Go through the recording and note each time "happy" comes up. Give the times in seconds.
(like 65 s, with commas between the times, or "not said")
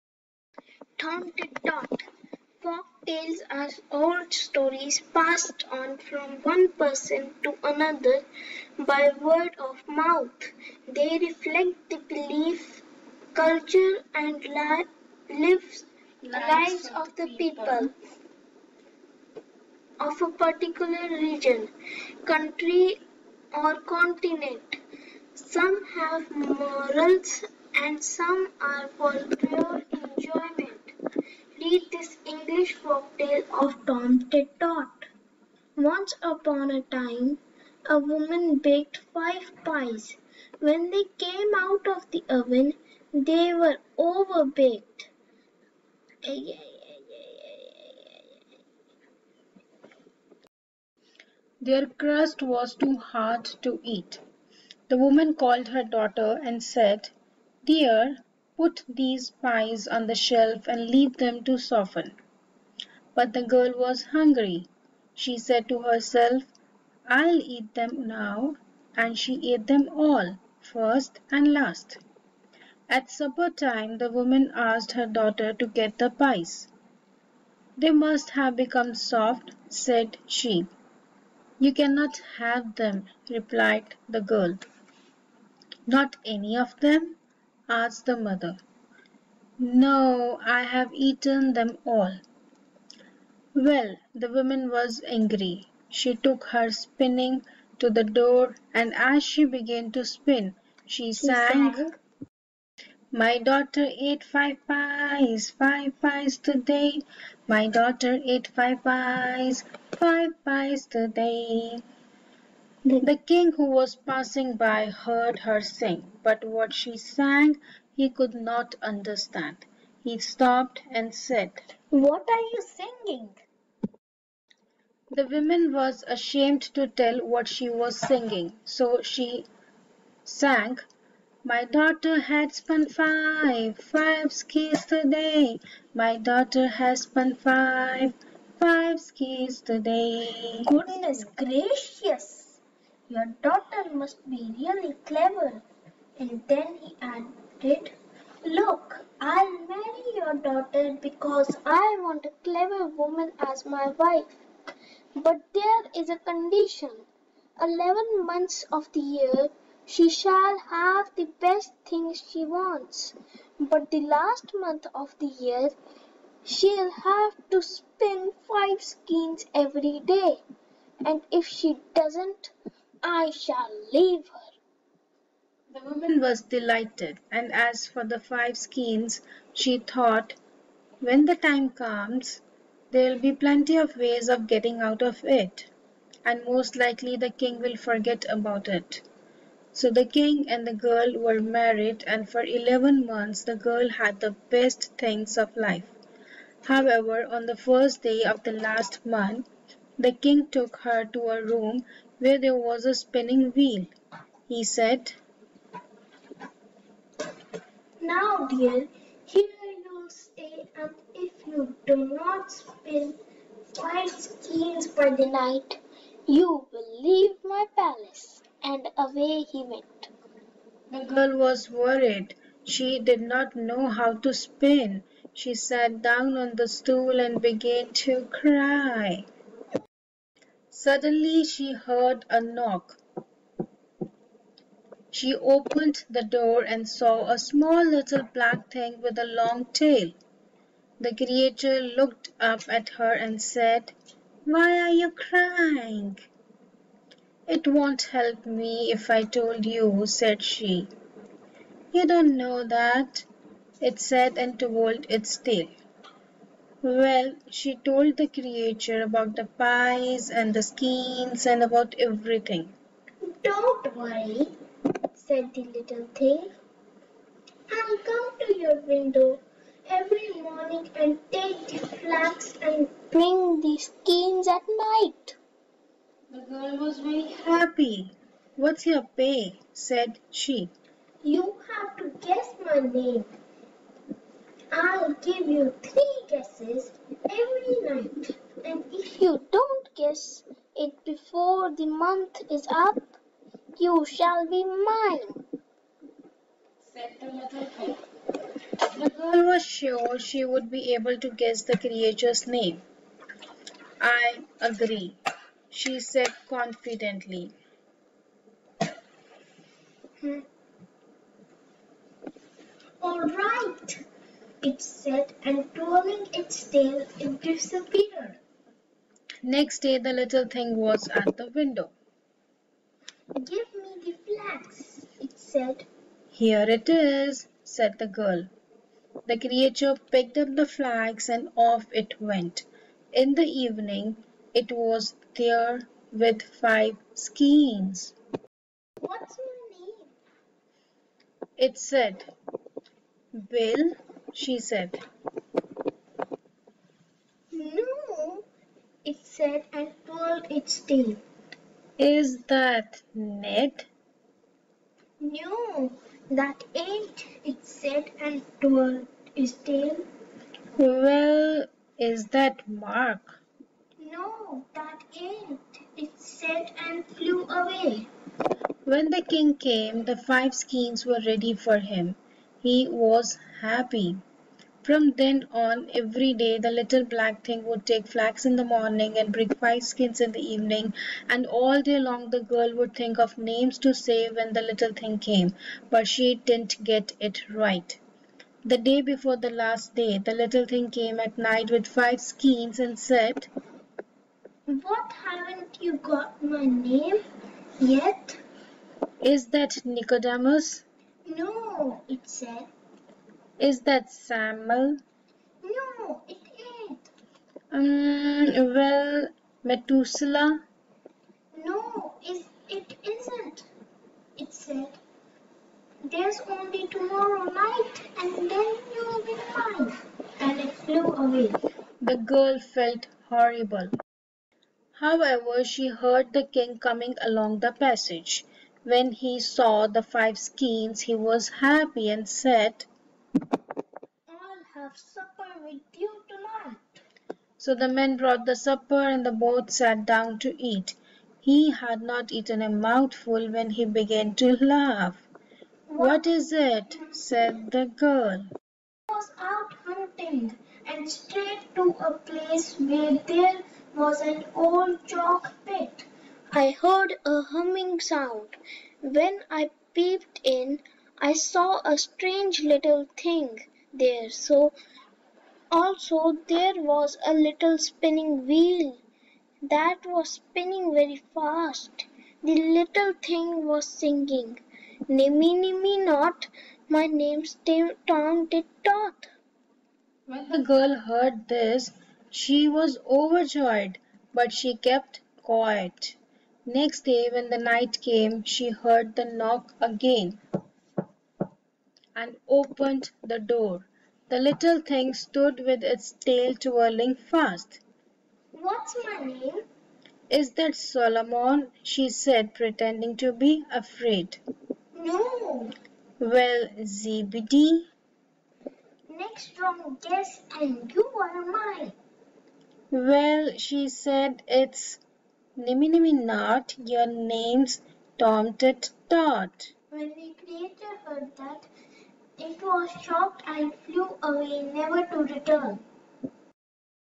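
277 s, 373 s, 431 s.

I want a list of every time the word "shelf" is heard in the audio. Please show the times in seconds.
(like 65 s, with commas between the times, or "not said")
60 s.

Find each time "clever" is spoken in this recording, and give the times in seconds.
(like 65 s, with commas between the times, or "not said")
145 s, 152 s.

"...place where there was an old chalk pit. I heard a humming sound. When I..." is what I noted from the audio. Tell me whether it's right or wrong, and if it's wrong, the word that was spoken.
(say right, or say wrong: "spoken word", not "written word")
right.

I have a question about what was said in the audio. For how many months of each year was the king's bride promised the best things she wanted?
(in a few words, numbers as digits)
11.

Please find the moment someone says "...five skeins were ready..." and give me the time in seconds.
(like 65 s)
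370 s.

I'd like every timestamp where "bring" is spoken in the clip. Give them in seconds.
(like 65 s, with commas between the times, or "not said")
273 s, 379 s.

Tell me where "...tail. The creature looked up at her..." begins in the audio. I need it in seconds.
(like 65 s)
239 s.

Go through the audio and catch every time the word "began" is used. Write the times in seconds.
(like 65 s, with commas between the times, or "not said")
99 s, 227 s, 443 s.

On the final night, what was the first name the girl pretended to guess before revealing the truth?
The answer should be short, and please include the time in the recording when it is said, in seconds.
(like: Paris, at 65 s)
Solomon, at 500 s.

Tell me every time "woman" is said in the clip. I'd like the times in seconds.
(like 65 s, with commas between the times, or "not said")
38 s, 54 s, 74 s, 94 s, 125 s, 152 s, 175 s.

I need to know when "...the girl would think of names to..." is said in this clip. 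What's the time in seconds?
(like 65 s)
382 s.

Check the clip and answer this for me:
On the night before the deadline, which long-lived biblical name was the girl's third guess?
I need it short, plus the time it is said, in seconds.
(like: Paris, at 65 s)
Methuselah, at 409 s.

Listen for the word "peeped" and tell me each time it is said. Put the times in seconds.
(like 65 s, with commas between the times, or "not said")
459 s.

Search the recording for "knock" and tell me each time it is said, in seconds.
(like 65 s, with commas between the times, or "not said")
232 s, 489 s.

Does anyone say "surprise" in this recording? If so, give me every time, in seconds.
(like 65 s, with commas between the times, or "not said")
not said.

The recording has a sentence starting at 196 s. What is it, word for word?
However, on the first day of the last month, the king took her to a room where there was a spinning wheel.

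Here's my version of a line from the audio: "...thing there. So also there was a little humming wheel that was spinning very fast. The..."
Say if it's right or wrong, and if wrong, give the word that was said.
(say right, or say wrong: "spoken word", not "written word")
wrong: "spinning", not "humming".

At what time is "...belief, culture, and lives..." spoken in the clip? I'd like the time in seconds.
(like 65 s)
12 s.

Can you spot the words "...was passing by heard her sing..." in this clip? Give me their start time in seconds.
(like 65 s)
113 s.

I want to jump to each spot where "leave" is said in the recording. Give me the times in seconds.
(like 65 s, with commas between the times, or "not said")
60 s, 173 s, 217 s.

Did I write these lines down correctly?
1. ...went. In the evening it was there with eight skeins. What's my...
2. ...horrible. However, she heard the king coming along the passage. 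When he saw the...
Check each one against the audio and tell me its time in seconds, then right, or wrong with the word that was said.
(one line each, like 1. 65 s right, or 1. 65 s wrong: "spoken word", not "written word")
1. 332 s wrong: "five", not "eight"
2. 423 s right.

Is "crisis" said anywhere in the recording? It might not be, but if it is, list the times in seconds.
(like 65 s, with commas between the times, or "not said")
not said.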